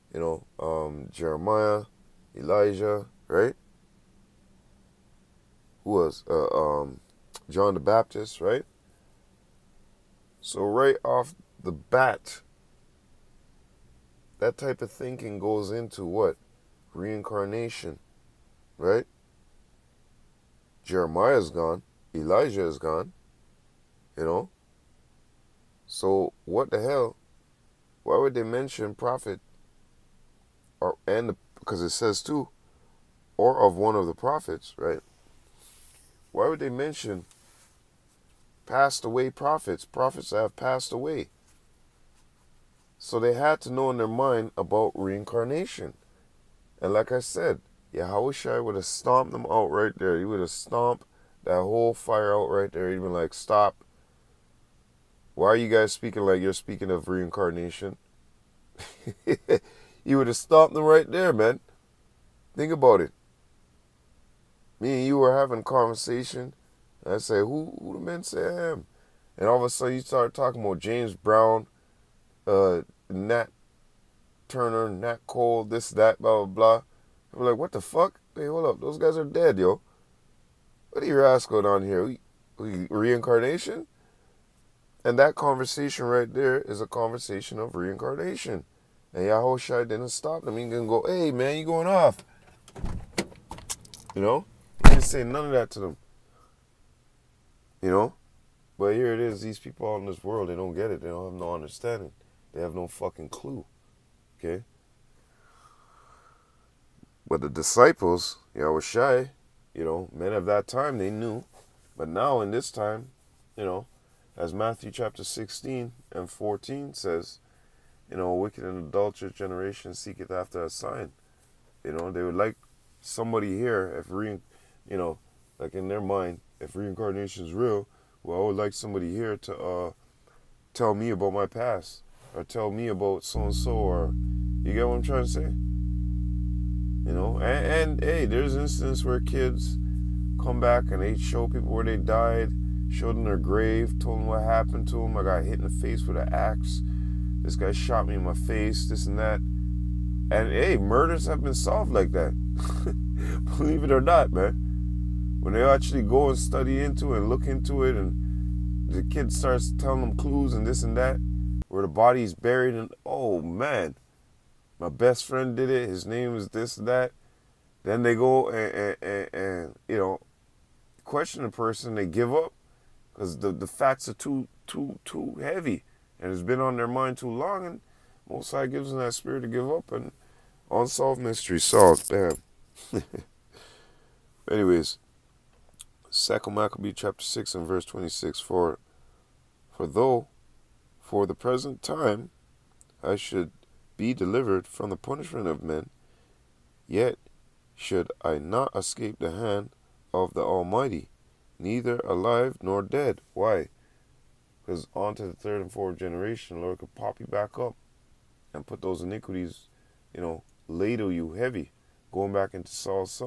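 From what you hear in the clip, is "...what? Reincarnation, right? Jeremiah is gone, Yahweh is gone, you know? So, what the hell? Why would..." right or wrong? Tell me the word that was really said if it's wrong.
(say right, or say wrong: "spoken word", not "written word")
wrong: "Elijah", not "Yahweh".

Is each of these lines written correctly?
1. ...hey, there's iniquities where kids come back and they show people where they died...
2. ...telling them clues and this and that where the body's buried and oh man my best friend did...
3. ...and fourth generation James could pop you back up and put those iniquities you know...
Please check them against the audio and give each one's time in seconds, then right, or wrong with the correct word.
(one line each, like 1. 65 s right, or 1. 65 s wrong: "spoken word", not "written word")
1. 138 s wrong: "instances", not "iniquities"
2. 159 s right
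3. 205 s wrong: "Lord", not "James".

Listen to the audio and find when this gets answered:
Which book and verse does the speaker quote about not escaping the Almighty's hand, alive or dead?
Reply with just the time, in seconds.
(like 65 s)
186 s.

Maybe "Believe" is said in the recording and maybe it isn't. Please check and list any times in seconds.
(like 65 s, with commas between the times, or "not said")
153 s.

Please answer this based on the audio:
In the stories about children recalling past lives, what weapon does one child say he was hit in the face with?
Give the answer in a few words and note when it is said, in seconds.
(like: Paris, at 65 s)
An axe, at 146 s.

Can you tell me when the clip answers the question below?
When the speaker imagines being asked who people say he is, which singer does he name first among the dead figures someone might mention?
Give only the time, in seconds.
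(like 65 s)
70 s.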